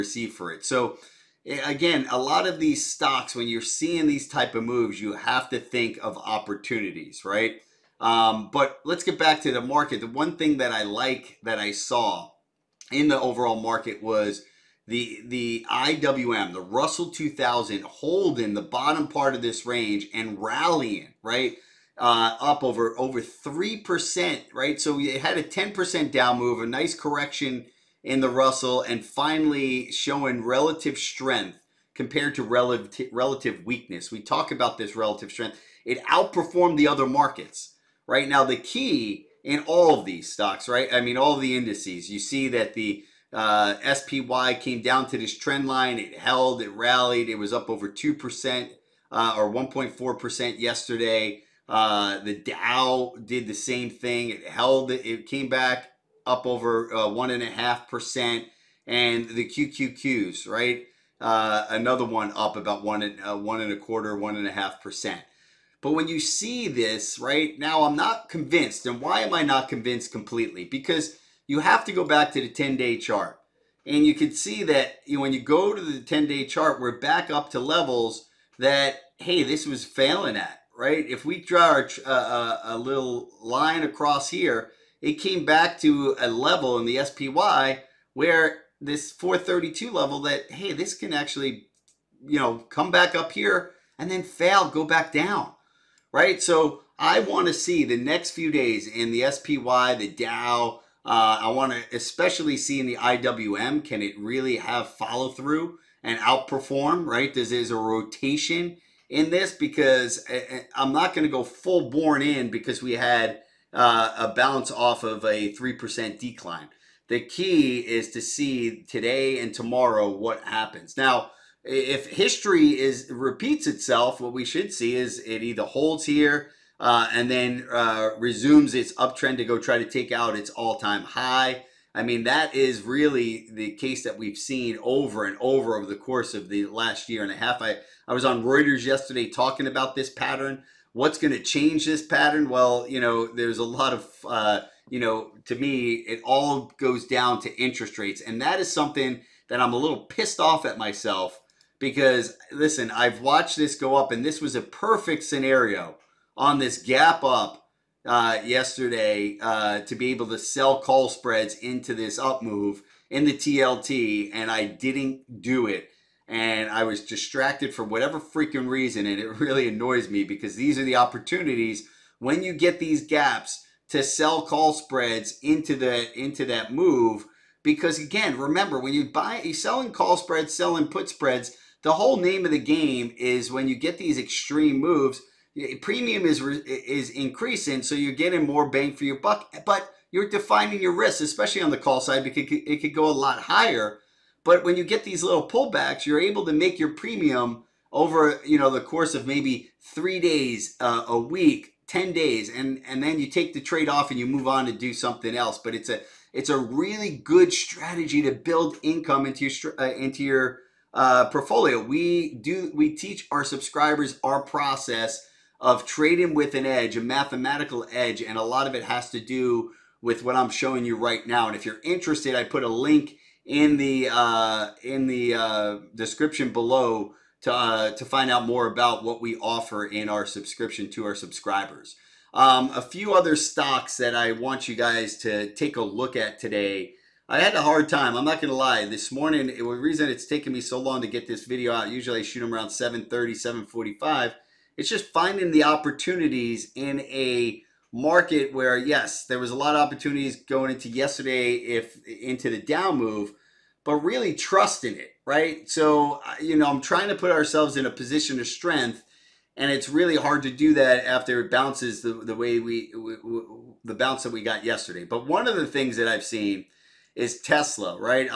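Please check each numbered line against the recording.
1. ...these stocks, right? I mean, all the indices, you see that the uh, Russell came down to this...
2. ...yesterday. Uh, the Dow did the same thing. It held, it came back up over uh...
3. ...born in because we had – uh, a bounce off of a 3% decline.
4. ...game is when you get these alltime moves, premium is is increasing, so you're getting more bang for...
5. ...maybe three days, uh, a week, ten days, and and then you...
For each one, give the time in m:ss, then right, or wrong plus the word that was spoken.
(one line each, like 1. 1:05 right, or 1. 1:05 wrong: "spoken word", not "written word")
1. 0:40 wrong: "SPY", not "Russell"
2. 0:50 right
3. 1:51 right
4. 3:02 wrong: "extreme", not "alltime"
5. 3:19 right.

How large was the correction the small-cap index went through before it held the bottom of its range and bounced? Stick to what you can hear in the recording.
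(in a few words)
10 percent.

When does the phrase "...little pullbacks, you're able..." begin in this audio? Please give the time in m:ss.
3:15.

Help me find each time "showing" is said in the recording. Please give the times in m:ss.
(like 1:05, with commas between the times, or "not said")
0:29, 3:40.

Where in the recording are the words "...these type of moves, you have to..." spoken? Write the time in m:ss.
0:04.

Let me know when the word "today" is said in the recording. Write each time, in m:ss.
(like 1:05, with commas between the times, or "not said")
1:58, 3:56.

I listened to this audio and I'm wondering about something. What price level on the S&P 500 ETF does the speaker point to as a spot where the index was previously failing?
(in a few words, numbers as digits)
432.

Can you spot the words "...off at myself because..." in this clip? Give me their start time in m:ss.
2:30.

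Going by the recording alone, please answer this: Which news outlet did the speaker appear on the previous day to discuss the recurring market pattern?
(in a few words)
Reuters.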